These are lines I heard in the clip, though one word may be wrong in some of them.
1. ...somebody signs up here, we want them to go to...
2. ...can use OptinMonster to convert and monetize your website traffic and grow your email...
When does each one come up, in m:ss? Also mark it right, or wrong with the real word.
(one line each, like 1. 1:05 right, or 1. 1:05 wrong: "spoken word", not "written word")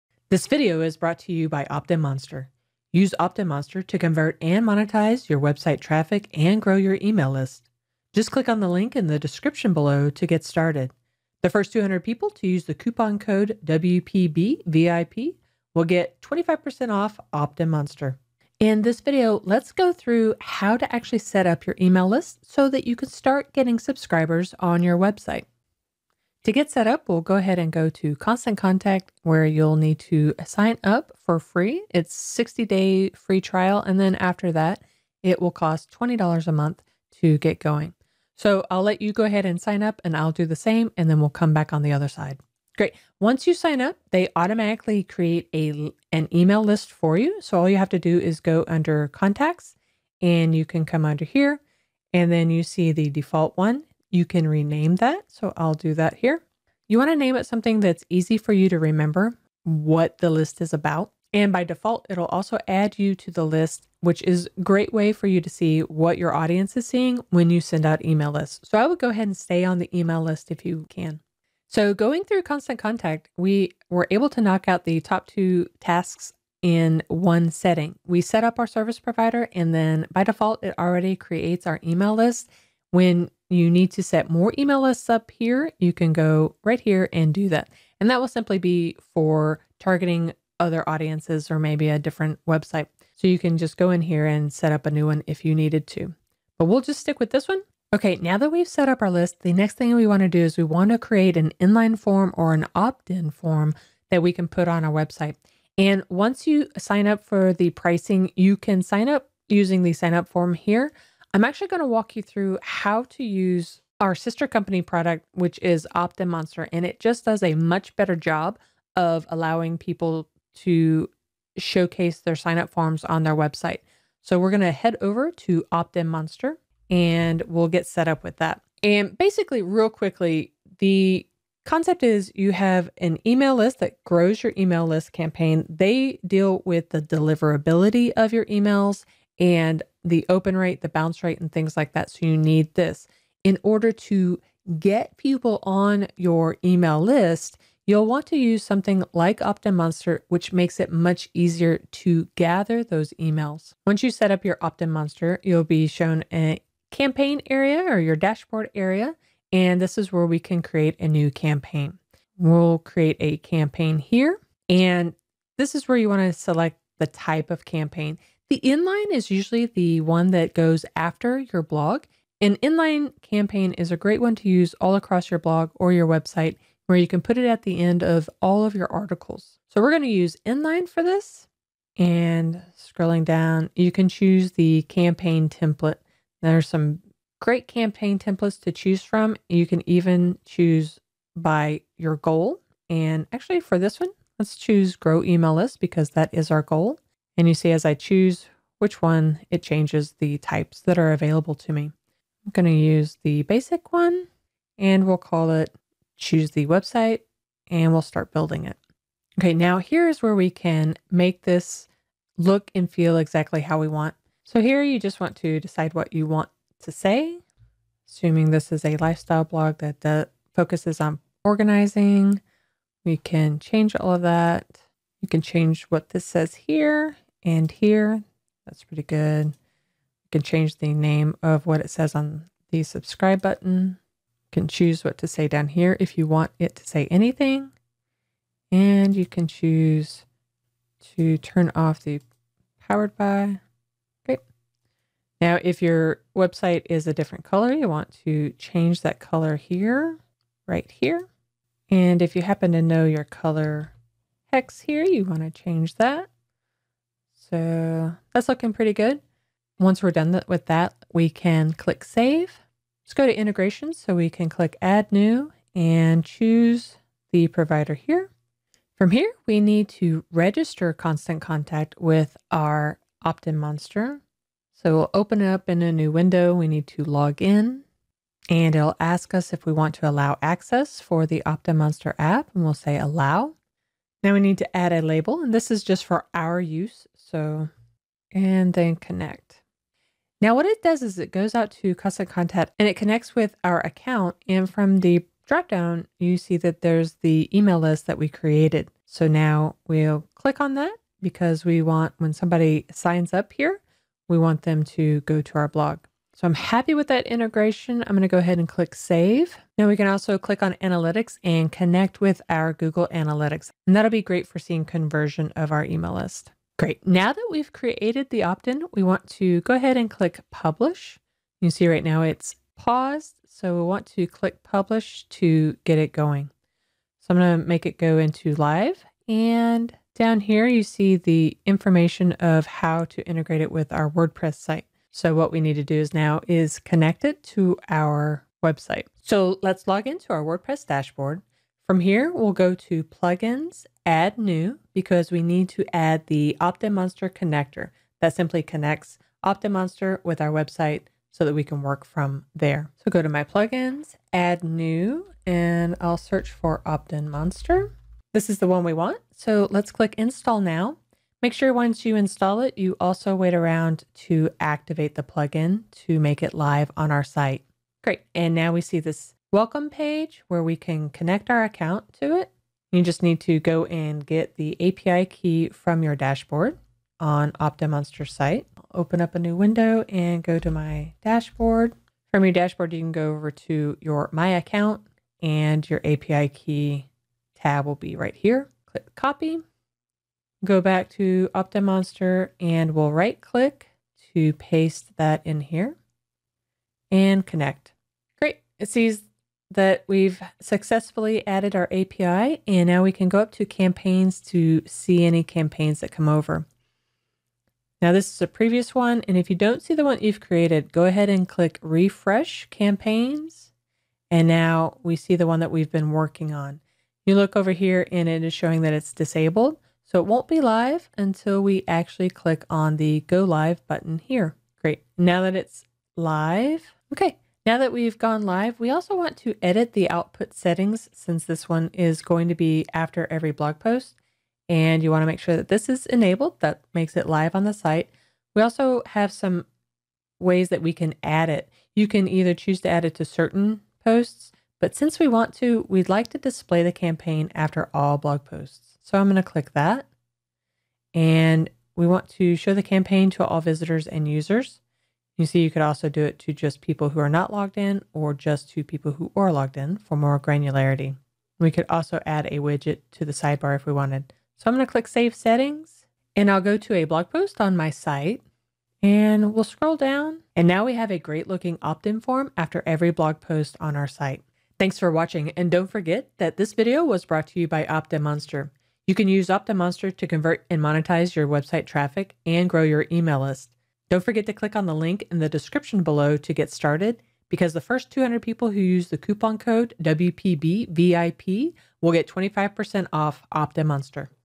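1. 5:02 right
2. 7:59 right.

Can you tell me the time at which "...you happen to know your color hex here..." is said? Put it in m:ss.
4:12.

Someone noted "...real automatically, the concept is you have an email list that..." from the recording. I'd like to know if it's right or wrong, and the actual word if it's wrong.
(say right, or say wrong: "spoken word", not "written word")
wrong: "quickly", not "automatically".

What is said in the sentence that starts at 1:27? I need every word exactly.
And that will simply be for targeting other audiences or maybe a different website.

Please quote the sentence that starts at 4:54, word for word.
And from the dropdown, you see that there's the email list that we created.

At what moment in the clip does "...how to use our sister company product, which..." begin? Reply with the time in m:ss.
1:52.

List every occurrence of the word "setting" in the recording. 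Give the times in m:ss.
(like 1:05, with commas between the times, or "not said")
1:17, 7:10, 7:45.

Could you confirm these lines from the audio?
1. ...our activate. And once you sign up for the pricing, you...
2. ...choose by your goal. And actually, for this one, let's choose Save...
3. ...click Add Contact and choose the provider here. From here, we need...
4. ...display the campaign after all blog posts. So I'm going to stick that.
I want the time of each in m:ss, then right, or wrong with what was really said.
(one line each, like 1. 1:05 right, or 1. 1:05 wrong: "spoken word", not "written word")
1. 1:44 wrong: "website", not "activate"
2. 3:10 wrong: "Grow", not "Save"
3. 4:24 wrong: "New", not "Contact"
4. 7:26 wrong: "click", not "stick".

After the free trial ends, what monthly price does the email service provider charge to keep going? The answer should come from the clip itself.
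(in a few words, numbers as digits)
$20.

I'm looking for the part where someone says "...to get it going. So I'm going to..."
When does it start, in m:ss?
5:25.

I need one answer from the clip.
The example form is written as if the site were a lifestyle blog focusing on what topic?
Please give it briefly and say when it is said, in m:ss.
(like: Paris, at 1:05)
Organizing, at 3:41.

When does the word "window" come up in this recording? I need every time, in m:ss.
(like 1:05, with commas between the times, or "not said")
4:36, 6:19.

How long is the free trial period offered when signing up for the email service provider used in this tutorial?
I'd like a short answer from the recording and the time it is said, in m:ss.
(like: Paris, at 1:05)
60 days, at 0:32.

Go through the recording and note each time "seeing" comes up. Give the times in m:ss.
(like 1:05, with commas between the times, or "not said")
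1:06, 5:14.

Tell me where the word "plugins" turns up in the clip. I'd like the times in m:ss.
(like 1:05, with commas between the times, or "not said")
5:43, 5:53, 6:05.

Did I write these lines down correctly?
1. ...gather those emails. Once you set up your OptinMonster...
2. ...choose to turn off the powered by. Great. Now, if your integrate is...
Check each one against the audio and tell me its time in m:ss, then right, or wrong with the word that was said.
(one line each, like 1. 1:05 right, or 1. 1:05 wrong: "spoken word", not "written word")
1. 2:32 right
2. 3:59 wrong: "website", not "integrate".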